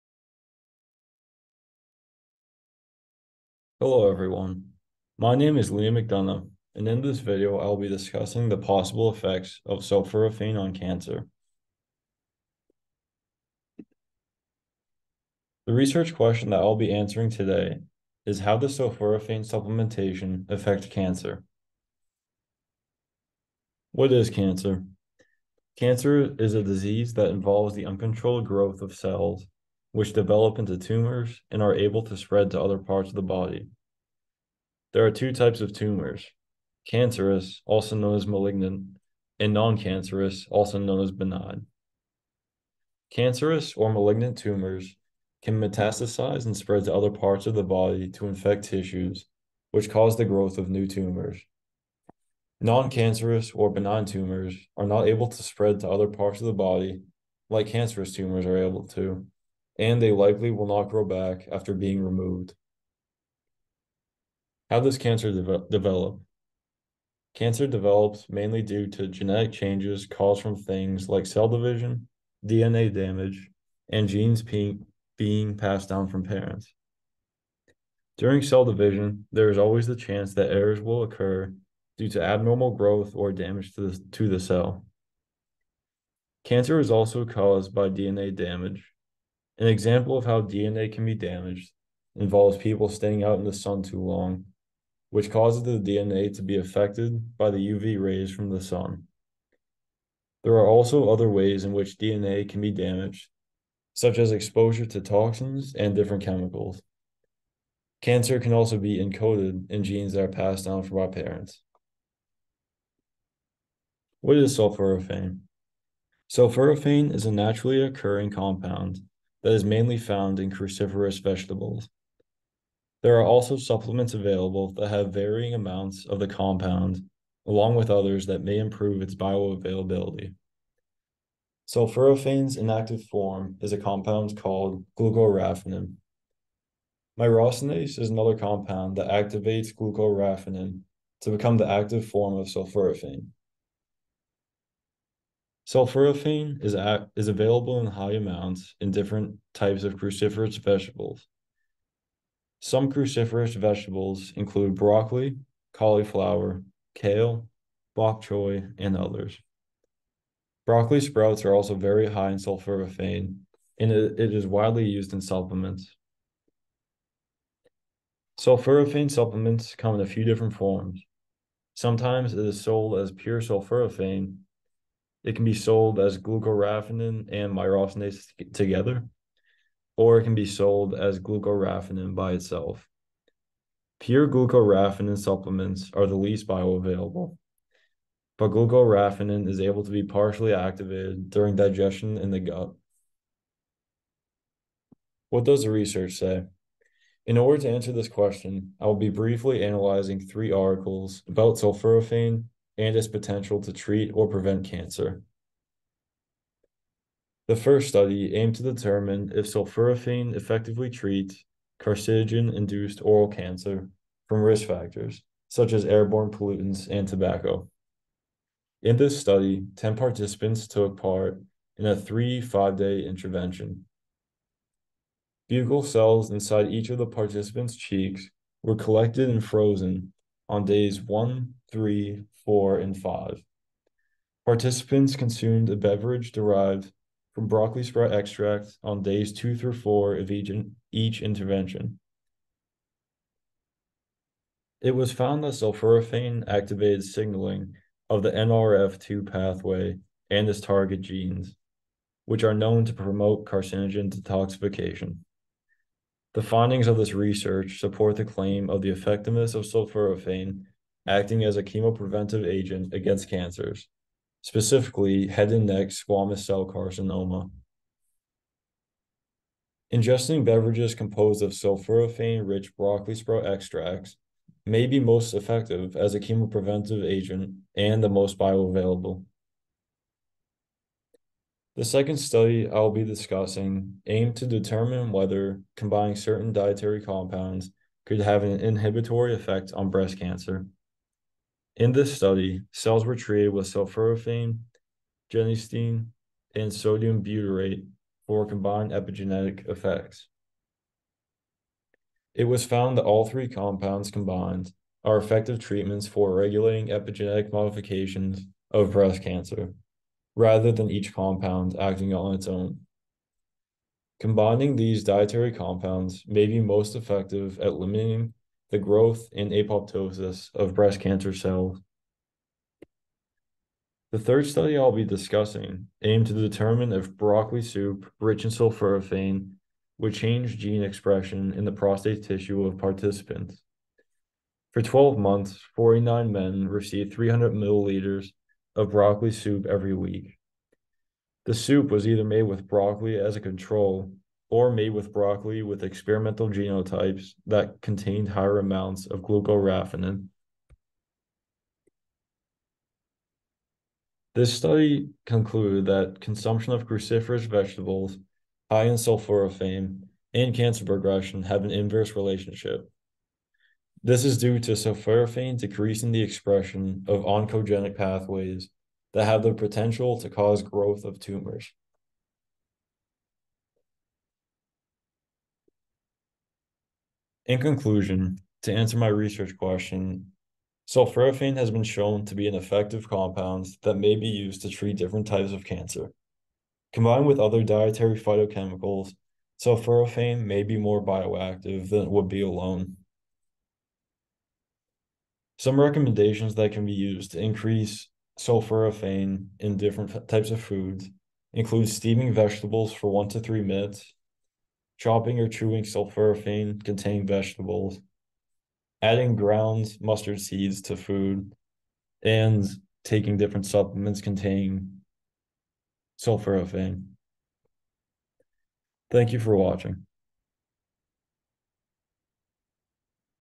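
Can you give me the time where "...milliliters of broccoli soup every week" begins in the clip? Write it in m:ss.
5:37.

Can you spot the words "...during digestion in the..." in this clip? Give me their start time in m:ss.
3:11.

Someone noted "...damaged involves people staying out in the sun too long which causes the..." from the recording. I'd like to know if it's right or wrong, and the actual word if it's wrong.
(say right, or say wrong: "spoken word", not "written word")
right.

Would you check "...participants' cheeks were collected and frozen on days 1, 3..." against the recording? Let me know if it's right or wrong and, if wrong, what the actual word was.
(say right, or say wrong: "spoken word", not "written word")
right.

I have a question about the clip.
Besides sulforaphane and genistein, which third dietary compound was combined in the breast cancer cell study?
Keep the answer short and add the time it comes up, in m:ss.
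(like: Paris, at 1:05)
sodium butyrate, at 4:56.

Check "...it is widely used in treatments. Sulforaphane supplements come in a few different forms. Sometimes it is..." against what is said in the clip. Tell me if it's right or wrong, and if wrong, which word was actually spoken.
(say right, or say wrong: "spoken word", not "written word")
wrong: "supplements", not "treatments".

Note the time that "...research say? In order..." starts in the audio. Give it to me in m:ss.
3:15.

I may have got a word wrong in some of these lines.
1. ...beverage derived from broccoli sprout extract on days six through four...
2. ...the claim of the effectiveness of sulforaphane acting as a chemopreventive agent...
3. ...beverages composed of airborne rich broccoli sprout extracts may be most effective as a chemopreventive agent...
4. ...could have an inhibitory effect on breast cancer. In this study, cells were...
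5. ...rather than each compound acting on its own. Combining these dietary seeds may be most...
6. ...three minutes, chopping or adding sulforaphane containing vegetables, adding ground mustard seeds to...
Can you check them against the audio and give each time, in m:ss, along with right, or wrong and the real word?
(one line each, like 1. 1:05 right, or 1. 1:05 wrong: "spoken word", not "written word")
1. 3:55 wrong: "two", not "six"
2. 4:18 right
3. 4:30 wrong: "sulforaphane", not "airborne"
4. 4:48 right
5. 5:10 wrong: "compounds", not "seeds"
6. 6:43 wrong: "chewing", not "adding".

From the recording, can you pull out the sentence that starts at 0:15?
The research question that I'll be answering today is how does sulforaphane supplementation affect cancer?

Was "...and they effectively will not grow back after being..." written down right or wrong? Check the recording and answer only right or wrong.
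wrong.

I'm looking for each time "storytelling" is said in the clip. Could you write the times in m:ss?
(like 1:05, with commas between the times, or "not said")
not said.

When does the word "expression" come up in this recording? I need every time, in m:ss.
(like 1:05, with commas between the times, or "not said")
5:30, 6:06.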